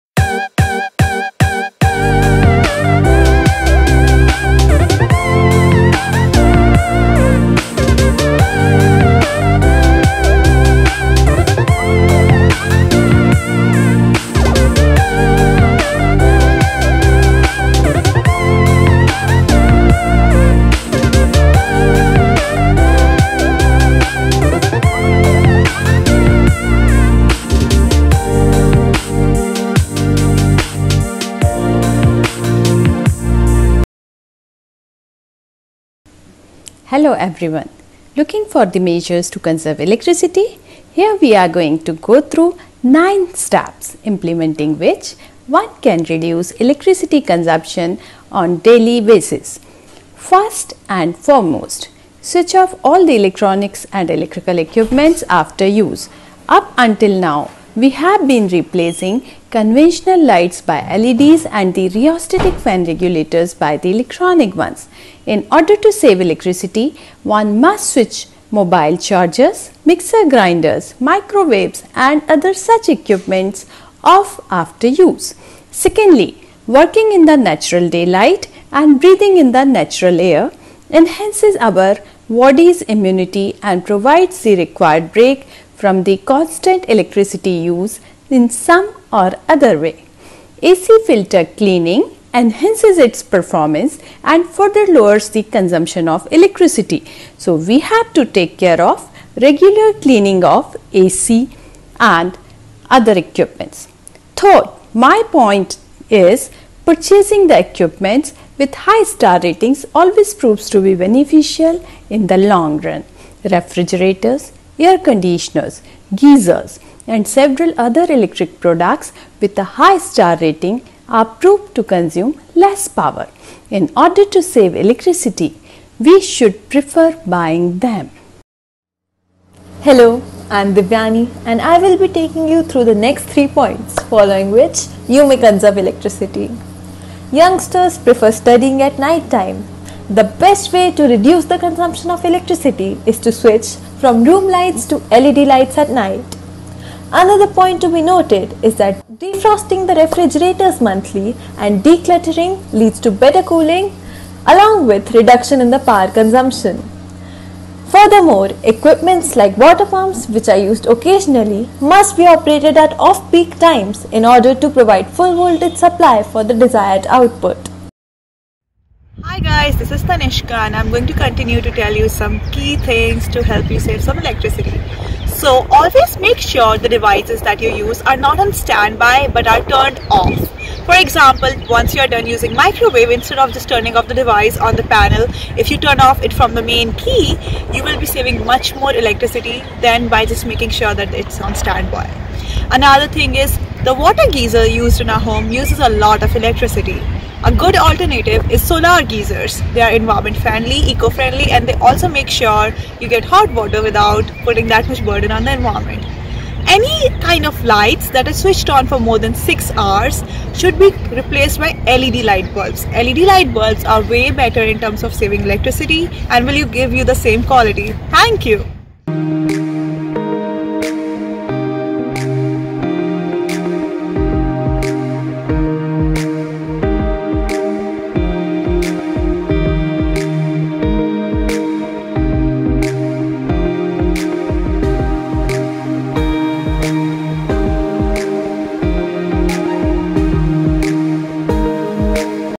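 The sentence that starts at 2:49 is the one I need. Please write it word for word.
Hi guys, this is Tanishka and I'm going to continue to tell you some key things to help you save some electricity.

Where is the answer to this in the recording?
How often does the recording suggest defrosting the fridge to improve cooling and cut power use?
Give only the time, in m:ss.
2:30.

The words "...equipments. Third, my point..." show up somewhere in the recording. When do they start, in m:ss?
1:43.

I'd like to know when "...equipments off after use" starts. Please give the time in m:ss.
1:12.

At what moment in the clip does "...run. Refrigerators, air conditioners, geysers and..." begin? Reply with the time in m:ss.
1:52.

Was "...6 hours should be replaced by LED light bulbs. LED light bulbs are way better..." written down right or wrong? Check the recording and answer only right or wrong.
right.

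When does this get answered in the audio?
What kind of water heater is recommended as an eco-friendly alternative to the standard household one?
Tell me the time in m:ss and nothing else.
3:18.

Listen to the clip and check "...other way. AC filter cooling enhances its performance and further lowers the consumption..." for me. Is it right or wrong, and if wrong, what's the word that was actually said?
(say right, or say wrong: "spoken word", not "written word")
wrong: "cleaning", not "cooling".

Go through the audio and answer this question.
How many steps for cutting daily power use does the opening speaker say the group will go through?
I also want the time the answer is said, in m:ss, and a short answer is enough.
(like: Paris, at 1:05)
9, at 0:42.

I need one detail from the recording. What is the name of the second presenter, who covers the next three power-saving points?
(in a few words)
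Divyani.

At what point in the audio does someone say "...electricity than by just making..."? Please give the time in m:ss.
3:08.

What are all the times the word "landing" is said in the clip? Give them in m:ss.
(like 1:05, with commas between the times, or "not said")
not said.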